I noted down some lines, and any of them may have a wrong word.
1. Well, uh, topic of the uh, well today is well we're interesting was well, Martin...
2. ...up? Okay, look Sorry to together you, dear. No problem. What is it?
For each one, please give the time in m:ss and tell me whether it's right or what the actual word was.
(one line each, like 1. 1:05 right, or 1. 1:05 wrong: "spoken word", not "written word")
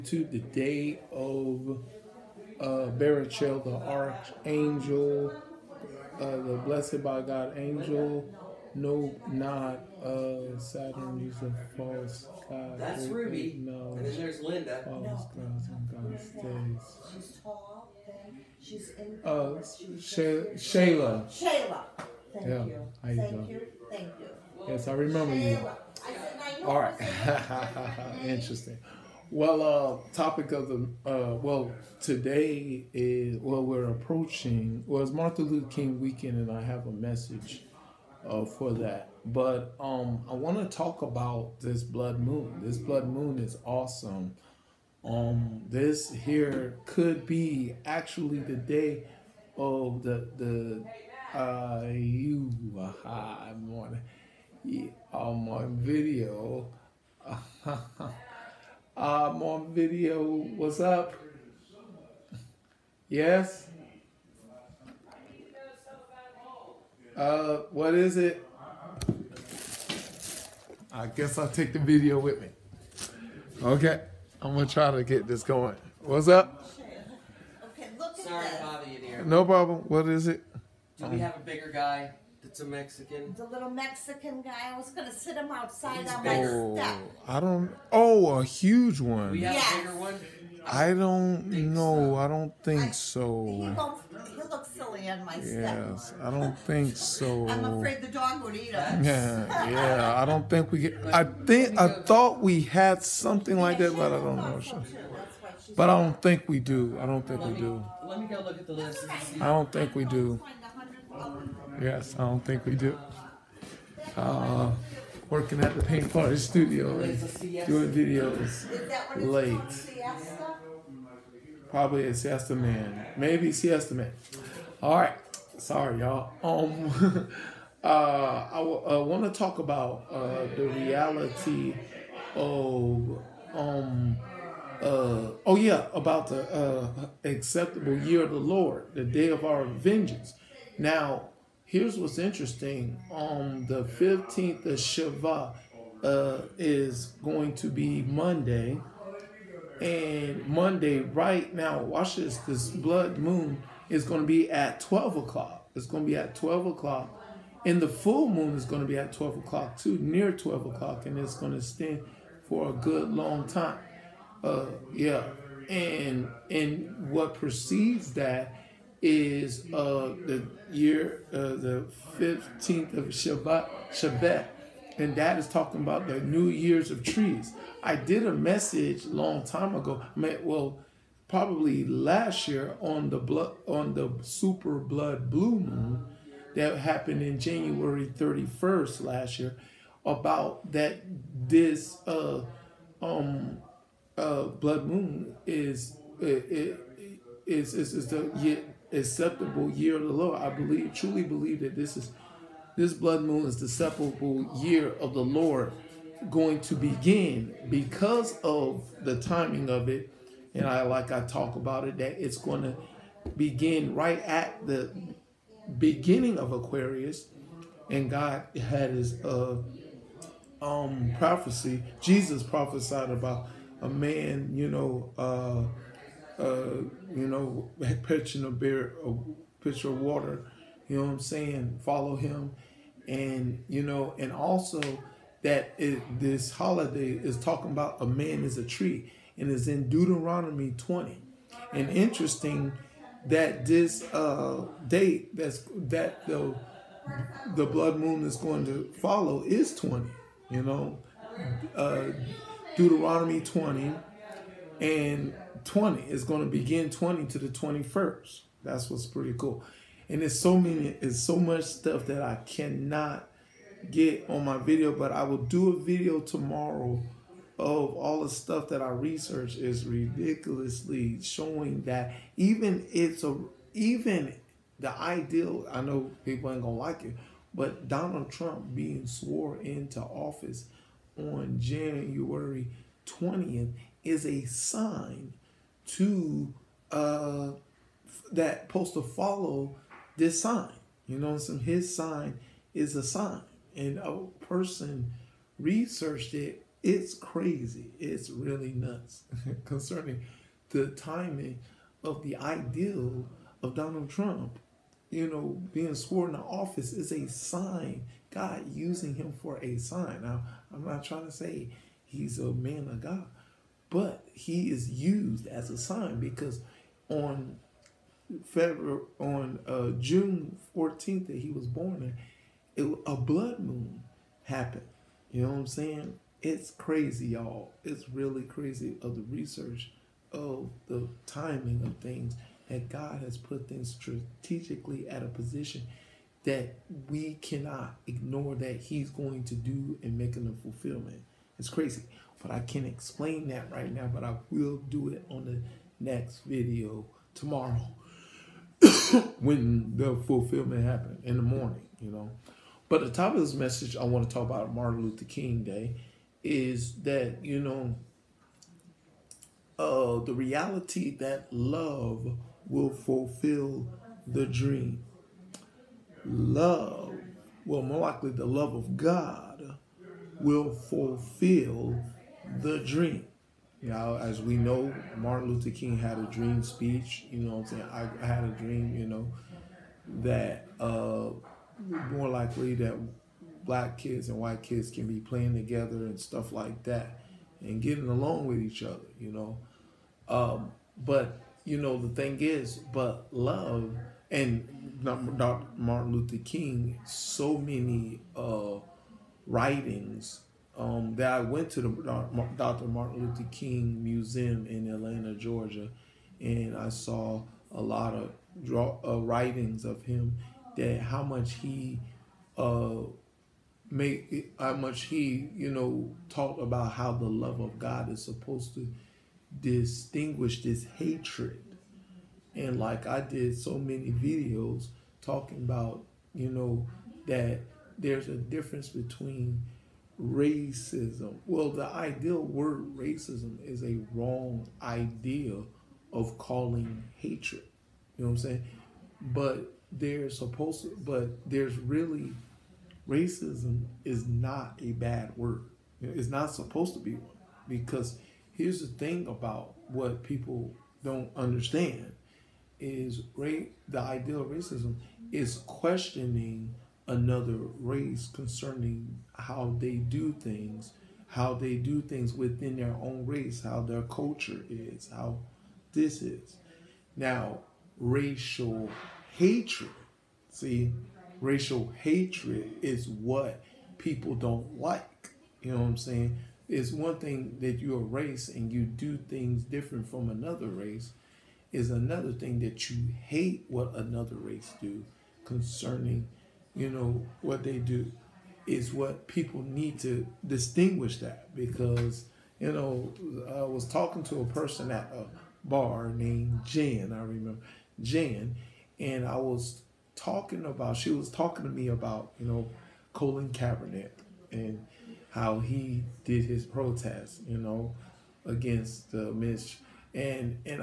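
1. 0:29 wrong: "approaching", not "interesting"
2. 1:16 wrong: "bother", not "together".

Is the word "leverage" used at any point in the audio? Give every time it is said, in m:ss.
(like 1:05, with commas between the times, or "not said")
not said.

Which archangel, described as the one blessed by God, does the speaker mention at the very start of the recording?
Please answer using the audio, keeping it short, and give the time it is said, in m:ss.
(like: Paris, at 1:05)
Barachiel, at 0:02.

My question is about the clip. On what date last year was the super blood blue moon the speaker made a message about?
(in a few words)
January 31st.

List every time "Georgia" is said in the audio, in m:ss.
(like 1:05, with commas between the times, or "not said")
6:45.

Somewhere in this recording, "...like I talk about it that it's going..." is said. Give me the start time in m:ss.
3:30.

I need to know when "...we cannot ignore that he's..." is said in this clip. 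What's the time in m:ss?
5:37.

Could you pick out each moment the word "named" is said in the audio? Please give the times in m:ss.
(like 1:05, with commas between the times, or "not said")
8:16.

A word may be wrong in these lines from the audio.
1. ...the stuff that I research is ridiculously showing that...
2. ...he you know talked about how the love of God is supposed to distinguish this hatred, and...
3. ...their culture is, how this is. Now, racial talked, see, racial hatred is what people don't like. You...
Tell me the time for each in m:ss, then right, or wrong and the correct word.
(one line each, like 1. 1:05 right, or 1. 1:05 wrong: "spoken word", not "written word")
1. 4:28 right
2. 6:55 right
3. 7:43 wrong: "hatred", not "talked".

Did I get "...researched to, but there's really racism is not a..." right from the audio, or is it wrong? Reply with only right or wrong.
wrong.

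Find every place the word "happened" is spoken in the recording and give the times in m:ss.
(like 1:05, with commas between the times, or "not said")
3:06, 5:24, 5:50.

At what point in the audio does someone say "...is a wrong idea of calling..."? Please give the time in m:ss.
7:13.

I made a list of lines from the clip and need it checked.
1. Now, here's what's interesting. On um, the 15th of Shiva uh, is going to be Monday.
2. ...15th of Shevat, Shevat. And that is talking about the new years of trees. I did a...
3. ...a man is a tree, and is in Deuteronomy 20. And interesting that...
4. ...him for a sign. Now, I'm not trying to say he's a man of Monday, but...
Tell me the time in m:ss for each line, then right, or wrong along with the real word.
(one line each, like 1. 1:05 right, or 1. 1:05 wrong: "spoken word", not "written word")
1. 2:20 right
2. 2:52 right
3. 3:58 right
4. 5:09 wrong: "God", not "Monday".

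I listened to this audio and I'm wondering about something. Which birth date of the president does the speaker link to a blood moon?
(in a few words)
June 14th.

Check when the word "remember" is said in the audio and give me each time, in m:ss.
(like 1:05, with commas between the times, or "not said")
0:24, 8:17.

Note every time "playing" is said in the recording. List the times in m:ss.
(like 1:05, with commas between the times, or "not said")
6:25.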